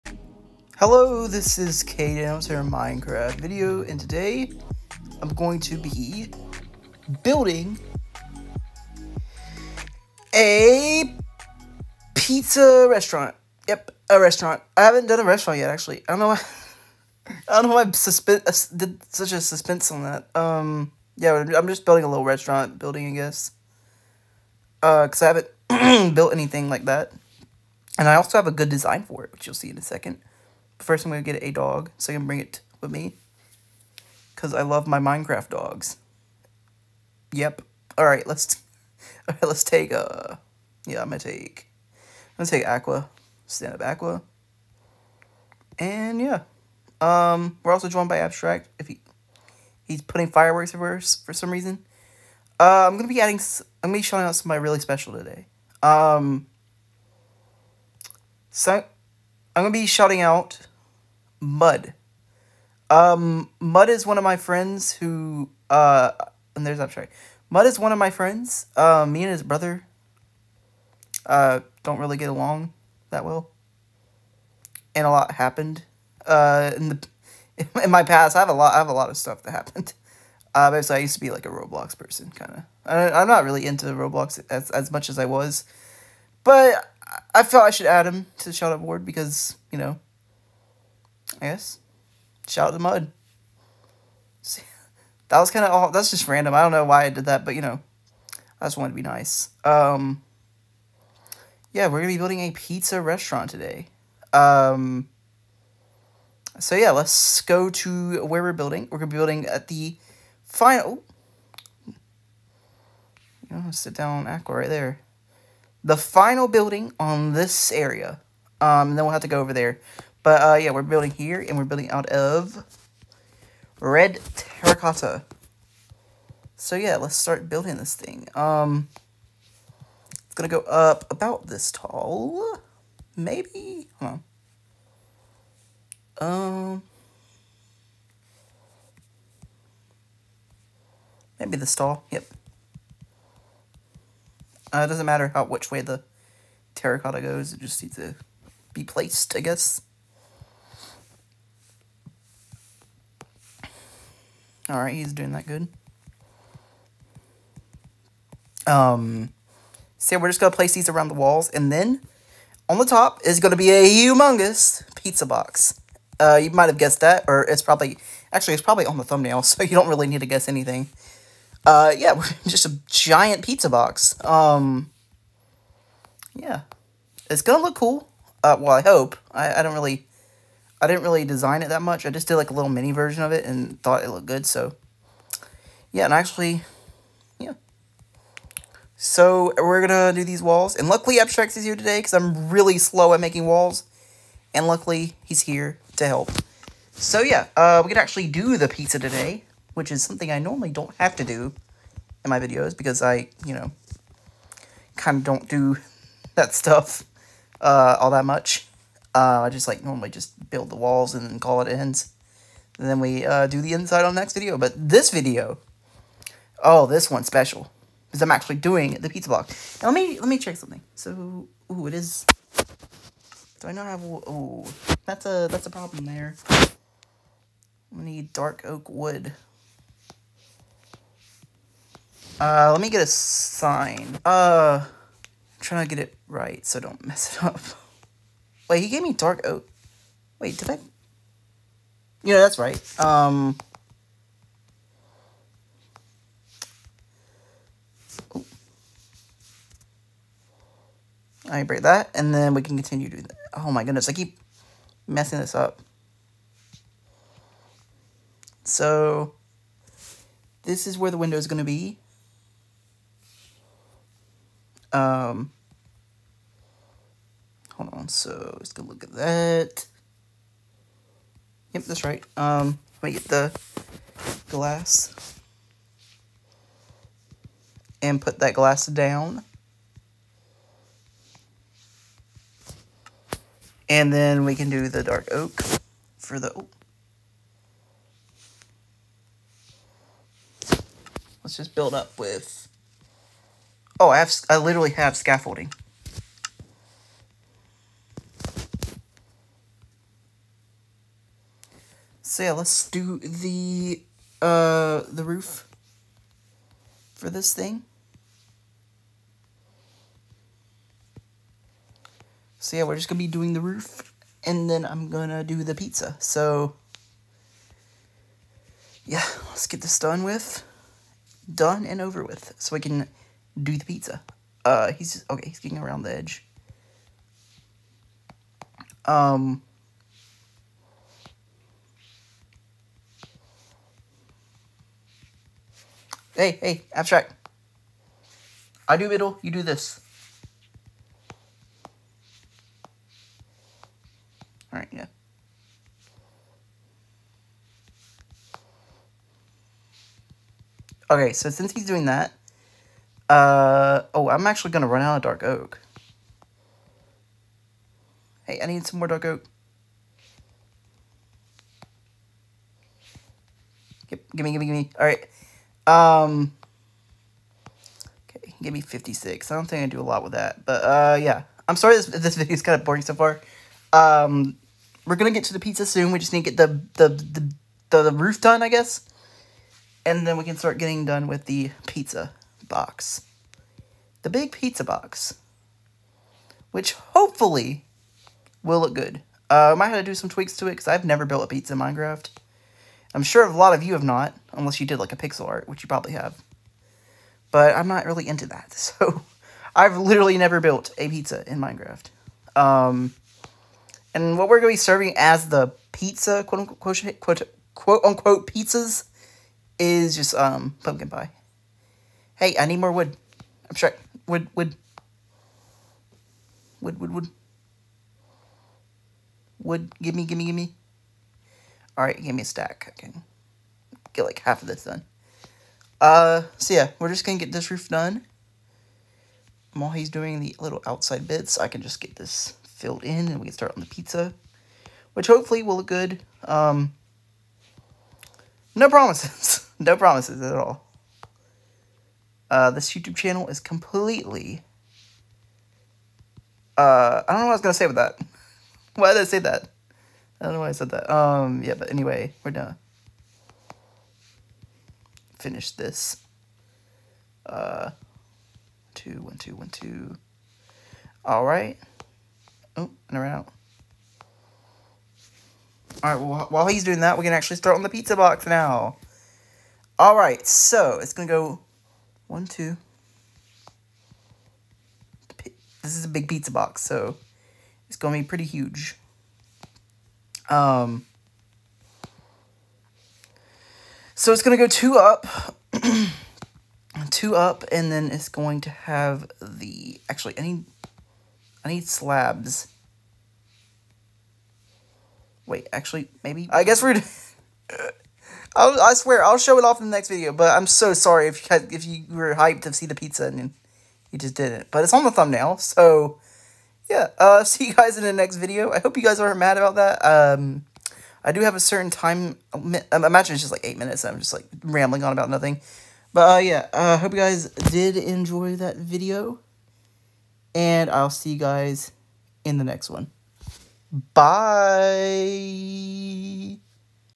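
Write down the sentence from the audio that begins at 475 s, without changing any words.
This is a big pizza box, so it's going to be pretty huge.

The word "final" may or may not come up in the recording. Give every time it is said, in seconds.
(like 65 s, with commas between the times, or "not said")
110 s, 115 s.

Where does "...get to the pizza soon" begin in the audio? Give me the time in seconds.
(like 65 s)
375 s.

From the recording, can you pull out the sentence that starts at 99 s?
Um, yeah, we're gonna be building a pizza restaurant today.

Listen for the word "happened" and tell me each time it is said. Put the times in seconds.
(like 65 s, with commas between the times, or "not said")
75 s, 79 s.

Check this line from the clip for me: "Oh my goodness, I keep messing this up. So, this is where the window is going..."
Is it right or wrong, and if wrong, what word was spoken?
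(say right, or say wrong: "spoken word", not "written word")
right.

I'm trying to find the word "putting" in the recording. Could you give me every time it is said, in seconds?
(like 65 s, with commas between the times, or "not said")
50 s.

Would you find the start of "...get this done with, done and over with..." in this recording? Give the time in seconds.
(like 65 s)
319 s.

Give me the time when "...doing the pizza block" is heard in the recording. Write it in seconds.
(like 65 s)
218 s.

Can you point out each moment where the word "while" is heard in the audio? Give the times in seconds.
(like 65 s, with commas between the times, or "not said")
429 s, 466 s.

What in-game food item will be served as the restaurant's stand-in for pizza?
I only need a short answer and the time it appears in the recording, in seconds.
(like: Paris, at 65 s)
Pumpkin pie, at 410 s.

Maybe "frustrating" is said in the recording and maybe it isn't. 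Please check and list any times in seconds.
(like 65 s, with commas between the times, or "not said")
not said.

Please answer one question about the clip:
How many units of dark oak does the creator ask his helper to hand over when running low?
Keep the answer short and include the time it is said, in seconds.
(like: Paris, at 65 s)
56, at 368 s.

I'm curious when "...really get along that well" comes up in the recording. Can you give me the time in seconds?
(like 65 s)
71 s.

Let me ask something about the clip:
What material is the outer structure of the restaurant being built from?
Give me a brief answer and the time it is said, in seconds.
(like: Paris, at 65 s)
Red terracotta, at 123 s.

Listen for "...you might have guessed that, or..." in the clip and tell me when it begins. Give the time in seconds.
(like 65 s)
166 s.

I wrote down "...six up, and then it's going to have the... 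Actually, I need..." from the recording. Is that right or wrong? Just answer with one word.
wrong.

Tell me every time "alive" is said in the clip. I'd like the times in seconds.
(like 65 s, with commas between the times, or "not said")
not said.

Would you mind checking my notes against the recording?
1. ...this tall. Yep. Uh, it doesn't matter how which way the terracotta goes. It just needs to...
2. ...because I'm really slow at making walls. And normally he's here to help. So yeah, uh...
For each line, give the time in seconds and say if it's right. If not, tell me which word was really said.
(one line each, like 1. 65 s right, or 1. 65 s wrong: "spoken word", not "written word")
1. 141 s right
2. 191 s wrong: "luckily", not "normally".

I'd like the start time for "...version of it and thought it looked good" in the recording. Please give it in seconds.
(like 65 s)
182 s.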